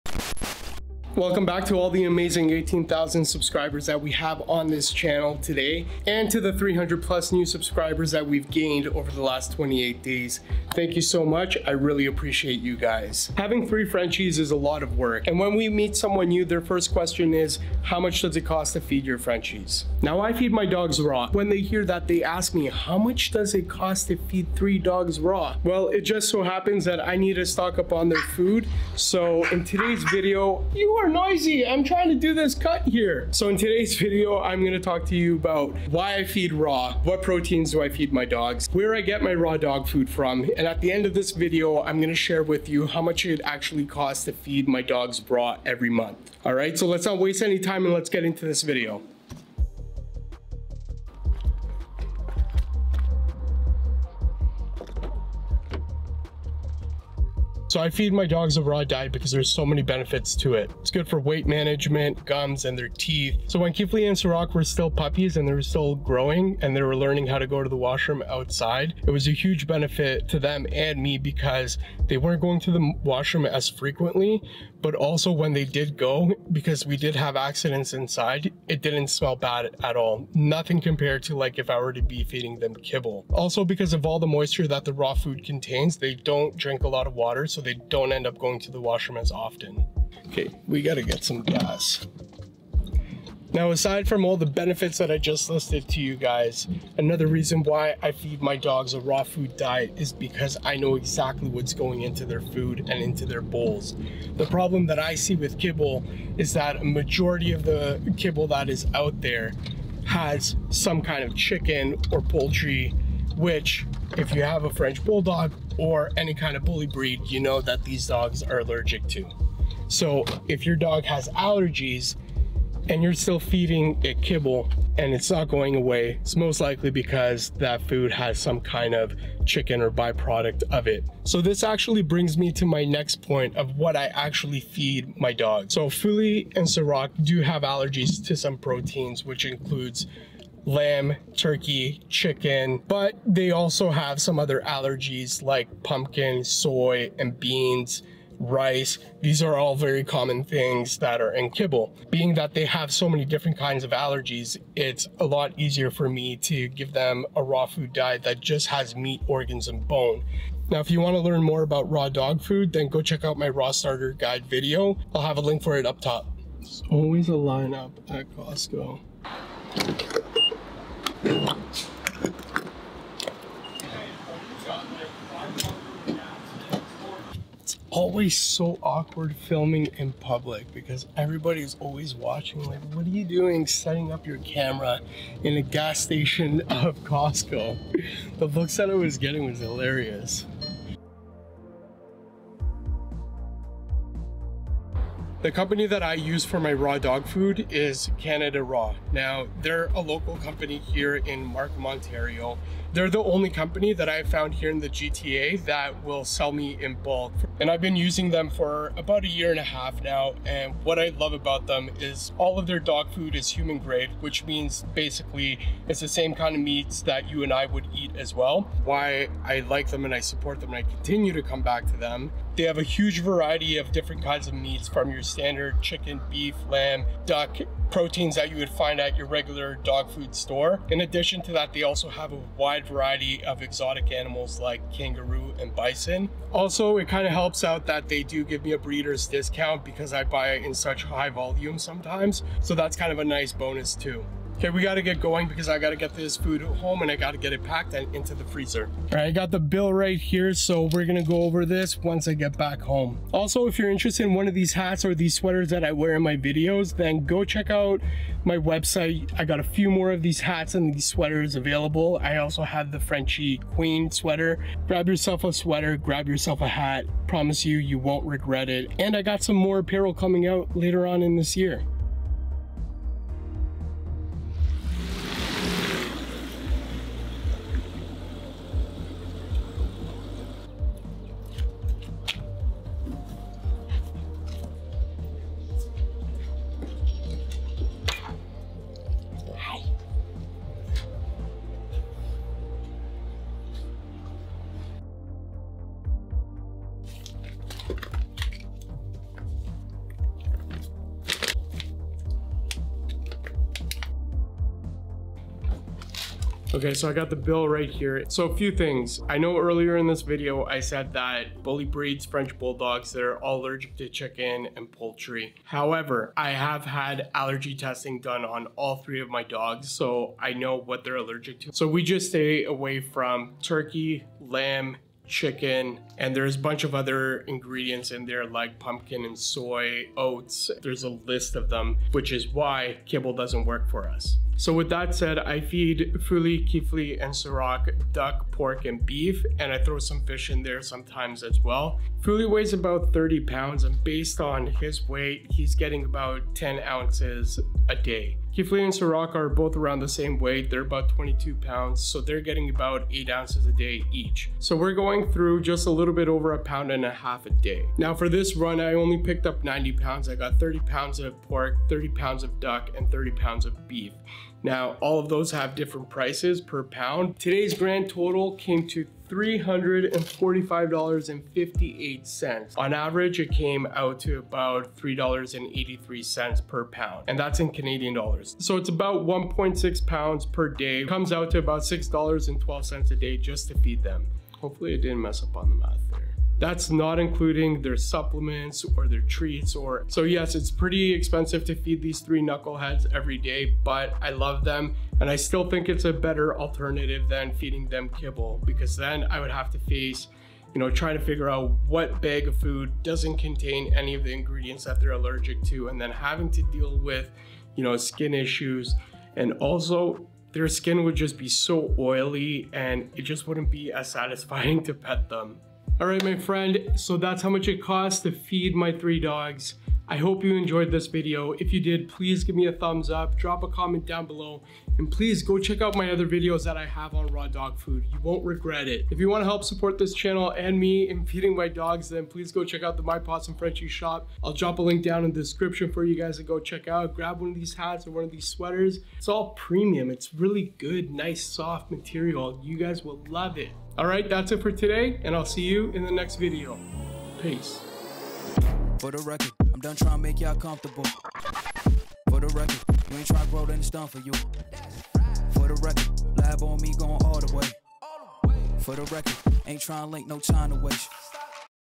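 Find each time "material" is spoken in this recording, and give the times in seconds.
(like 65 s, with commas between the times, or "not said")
441 s.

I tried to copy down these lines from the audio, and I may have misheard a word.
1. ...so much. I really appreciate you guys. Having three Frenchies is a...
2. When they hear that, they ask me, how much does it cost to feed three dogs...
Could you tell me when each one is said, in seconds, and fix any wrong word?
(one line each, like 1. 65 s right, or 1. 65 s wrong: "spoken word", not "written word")
1. 11 s right
2. 21 s right.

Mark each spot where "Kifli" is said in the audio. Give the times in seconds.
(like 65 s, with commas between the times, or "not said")
63 s, 336 s, 348 s.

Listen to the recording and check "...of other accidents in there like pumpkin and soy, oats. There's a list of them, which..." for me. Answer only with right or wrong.
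wrong.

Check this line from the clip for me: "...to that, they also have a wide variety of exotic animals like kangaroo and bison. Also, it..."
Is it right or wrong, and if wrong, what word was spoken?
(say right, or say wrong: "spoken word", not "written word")
right.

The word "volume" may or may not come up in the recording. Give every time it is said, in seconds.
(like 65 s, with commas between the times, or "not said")
241 s.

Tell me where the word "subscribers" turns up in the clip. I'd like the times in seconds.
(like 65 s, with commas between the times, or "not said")
3 s, 7 s.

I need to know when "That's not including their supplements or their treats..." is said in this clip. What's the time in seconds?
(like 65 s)
386 s.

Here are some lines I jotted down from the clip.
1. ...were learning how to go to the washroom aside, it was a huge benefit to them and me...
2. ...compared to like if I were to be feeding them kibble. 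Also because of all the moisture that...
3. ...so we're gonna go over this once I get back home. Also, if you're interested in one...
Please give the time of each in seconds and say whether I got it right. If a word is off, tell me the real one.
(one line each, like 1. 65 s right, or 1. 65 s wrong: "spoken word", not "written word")
1. 66 s wrong: "outside", not "aside"
2. 80 s right
3. 250 s right.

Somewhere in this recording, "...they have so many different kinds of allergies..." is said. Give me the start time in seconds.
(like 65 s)
152 s.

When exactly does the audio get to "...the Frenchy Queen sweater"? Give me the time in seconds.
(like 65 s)
262 s.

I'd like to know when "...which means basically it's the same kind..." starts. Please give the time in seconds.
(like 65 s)
214 s.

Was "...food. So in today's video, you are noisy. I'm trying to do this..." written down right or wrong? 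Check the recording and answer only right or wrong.
right.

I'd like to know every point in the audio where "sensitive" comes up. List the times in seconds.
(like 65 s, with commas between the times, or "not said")
not said.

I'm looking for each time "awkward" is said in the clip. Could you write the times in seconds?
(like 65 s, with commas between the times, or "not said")
178 s.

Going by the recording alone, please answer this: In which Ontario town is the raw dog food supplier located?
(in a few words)
Markham.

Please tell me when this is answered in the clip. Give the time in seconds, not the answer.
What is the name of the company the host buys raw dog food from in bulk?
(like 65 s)
198 s.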